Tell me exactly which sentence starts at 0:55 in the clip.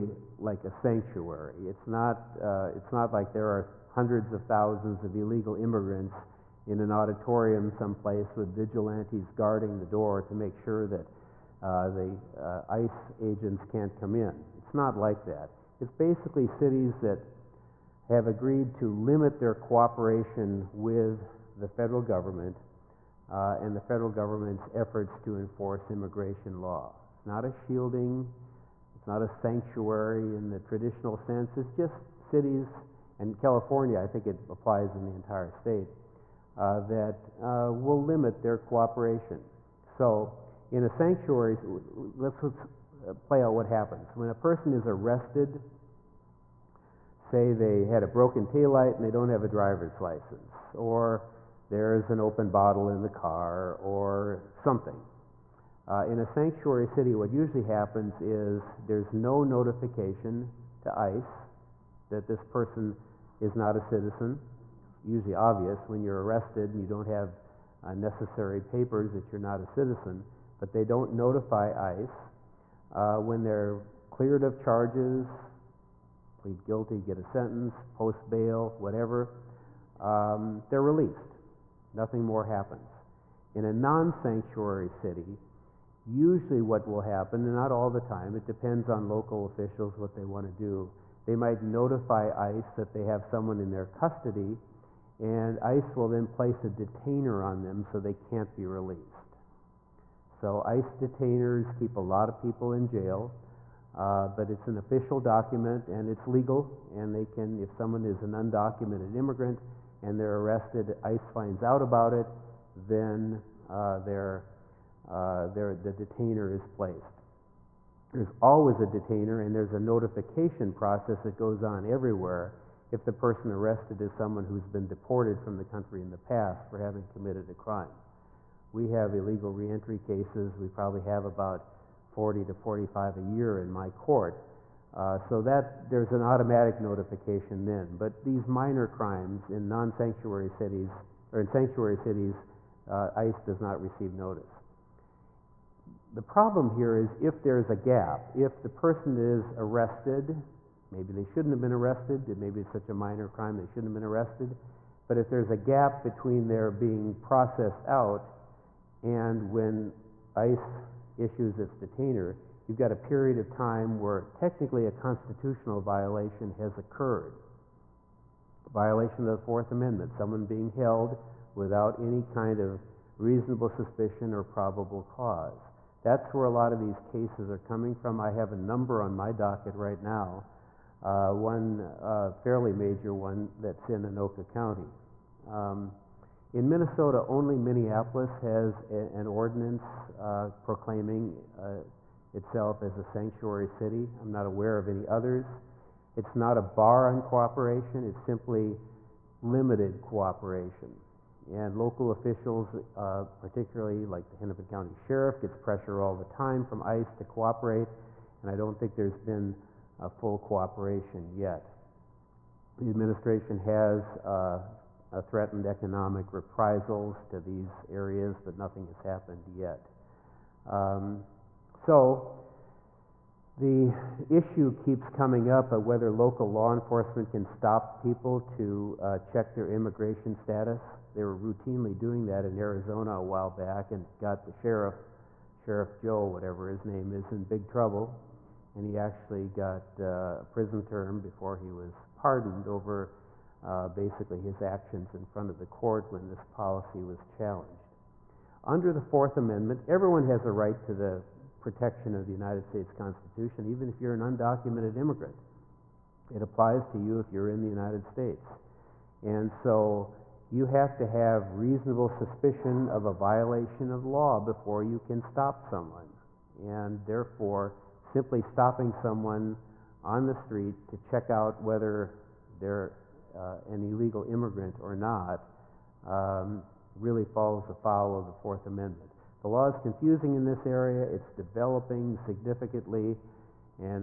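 Uh, in a sanctuary city, what usually happens is there's no notification to ICE that this person is not a citizen.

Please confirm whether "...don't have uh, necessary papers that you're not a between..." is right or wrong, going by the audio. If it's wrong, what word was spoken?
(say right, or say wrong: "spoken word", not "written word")
wrong: "citizen", not "between".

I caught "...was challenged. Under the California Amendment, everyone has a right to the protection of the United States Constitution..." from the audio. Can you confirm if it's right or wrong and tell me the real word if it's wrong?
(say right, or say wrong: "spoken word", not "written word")
wrong: "Fourth", not "California".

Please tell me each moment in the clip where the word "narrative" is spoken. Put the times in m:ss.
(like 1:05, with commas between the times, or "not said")
not said.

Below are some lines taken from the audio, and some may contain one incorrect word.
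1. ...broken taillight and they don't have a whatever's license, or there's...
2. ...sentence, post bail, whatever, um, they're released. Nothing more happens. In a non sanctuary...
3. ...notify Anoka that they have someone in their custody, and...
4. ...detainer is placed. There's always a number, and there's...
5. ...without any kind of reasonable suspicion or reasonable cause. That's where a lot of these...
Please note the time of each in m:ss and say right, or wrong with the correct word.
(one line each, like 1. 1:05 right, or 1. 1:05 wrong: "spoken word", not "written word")
1. 0:48 wrong: "driver", not "whatever"
2. 1:17 right
3. 1:31 wrong: "ICE", not "Anoka"
4. 1:55 wrong: "detainer", not "number"
5. 2:51 wrong: "probable", not "reasonable".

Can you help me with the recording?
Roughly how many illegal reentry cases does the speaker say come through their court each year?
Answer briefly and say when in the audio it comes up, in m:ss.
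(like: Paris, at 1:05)
40 to 45, at 2:12.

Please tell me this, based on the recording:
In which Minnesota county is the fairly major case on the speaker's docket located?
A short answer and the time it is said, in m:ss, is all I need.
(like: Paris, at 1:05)
Anoka County, at 3:04.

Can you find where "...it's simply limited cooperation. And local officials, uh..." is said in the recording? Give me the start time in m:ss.
3:18.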